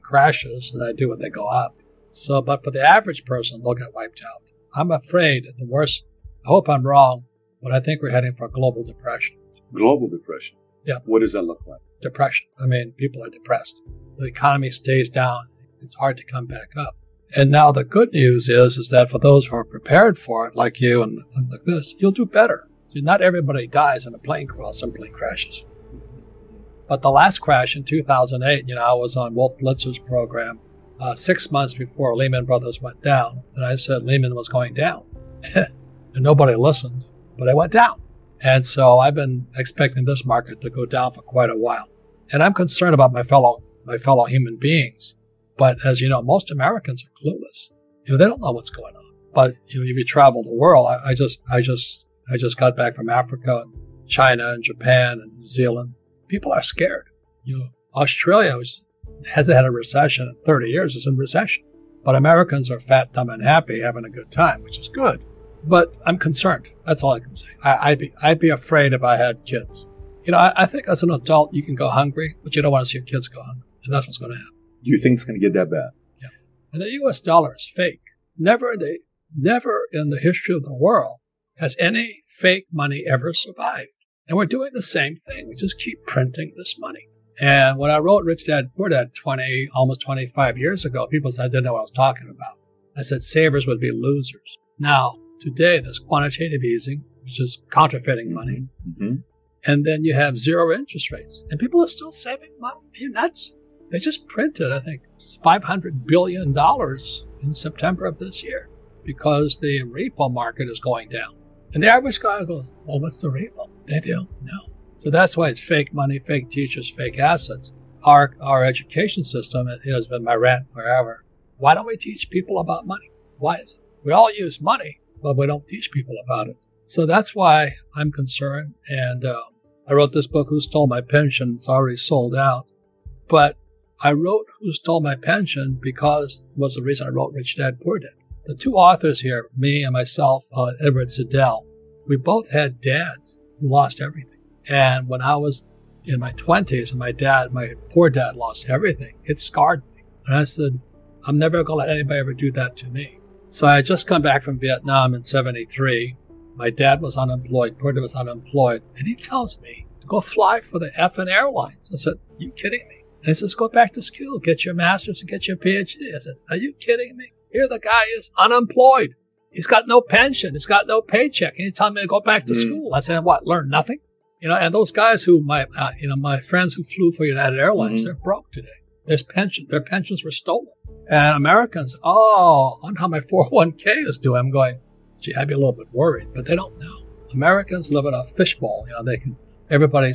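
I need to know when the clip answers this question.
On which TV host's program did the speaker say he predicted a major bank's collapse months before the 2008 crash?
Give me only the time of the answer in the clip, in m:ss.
0:29.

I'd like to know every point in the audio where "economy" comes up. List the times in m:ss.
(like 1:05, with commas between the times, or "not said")
0:14.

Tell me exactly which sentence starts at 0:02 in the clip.
So, but for the average person, they'll get wiped out.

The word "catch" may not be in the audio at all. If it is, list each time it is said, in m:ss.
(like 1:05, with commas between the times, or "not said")
not said.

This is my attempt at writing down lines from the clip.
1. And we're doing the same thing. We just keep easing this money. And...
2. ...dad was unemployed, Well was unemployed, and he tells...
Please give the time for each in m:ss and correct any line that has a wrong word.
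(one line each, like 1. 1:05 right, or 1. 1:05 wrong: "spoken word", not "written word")
1. 1:24 wrong: "printing", not "easing"
2. 2:36 wrong: "Porter", not "Well".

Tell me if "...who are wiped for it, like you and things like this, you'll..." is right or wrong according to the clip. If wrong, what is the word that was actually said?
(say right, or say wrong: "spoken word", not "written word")
wrong: "prepared", not "wiped".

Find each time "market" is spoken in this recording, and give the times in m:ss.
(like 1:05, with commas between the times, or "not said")
0:40, 1:50.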